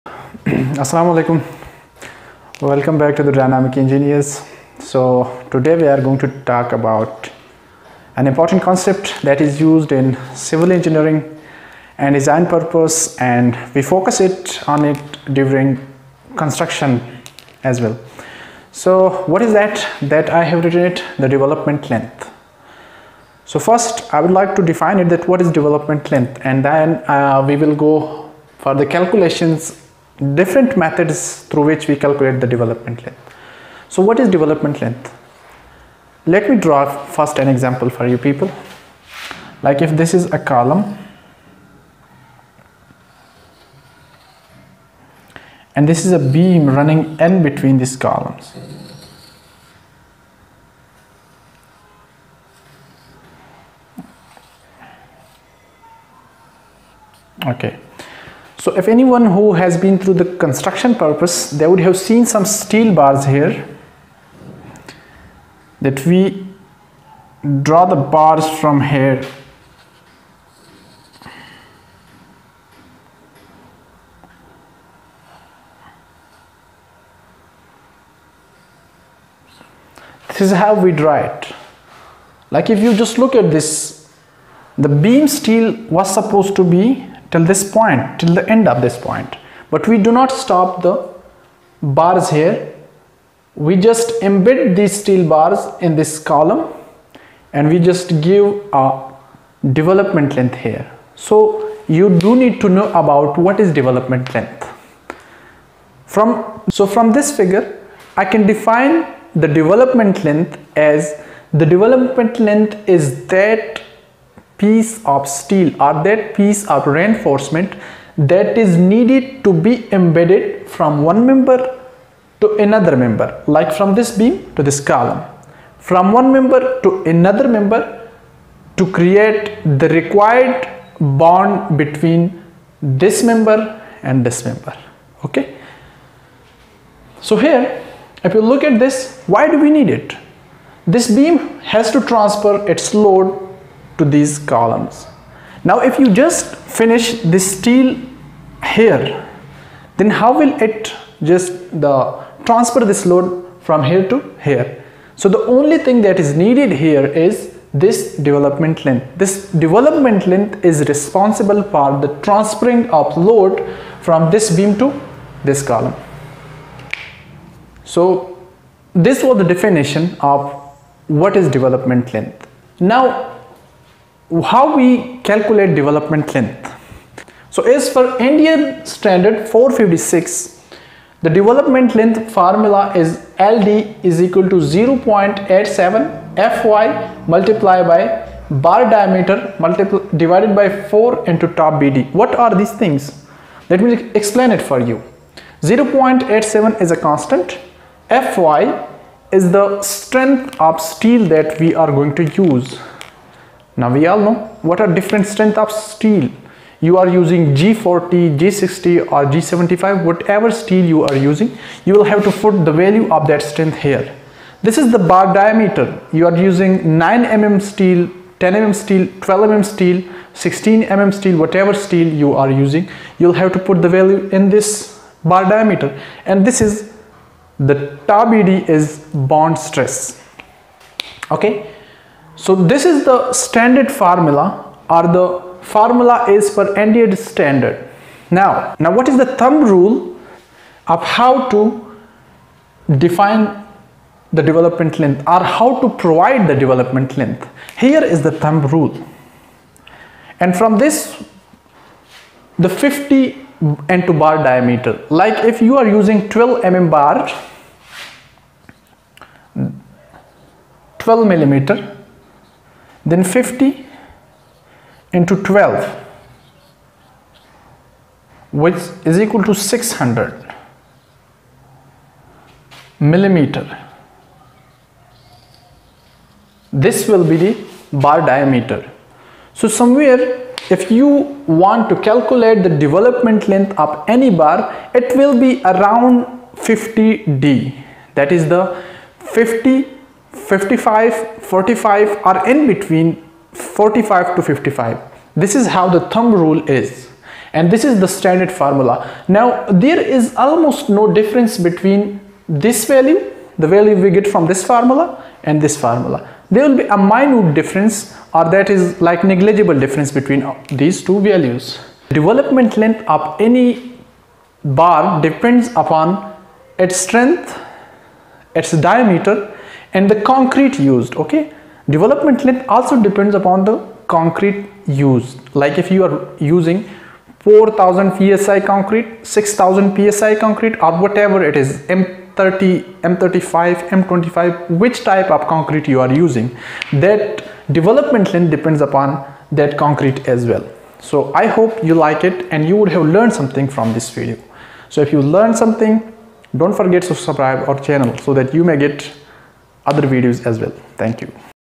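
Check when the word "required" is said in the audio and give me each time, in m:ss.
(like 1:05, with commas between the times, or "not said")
2:09.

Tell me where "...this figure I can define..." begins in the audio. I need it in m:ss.
1:47.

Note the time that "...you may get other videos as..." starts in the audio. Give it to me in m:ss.
5:48.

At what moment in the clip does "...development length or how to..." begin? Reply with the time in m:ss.
4:04.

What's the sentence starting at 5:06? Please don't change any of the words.
There will be a minute difference or that is like negligible difference between uh, these two values.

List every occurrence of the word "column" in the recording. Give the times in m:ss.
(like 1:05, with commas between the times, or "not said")
0:40, 0:47, 1:36, 2:04, 2:24, 2:45.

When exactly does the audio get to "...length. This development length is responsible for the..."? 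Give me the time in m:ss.
2:38.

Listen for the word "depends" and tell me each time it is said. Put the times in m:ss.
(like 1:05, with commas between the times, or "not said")
5:15, 5:23, 5:38.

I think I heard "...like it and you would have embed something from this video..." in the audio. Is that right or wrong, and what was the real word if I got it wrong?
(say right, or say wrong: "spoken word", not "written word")
wrong: "learned", not "embed".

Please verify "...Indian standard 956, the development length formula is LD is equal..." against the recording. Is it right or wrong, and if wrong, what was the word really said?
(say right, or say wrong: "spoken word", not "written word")
wrong: "456", not "956".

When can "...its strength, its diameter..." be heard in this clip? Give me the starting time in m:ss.
5:16.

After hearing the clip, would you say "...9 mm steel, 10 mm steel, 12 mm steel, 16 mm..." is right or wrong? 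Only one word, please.
right.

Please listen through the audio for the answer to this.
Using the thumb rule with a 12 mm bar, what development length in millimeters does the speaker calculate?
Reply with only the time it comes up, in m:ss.
4:29.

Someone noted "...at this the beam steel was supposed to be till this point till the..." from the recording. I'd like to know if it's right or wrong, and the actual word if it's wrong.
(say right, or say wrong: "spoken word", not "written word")
right.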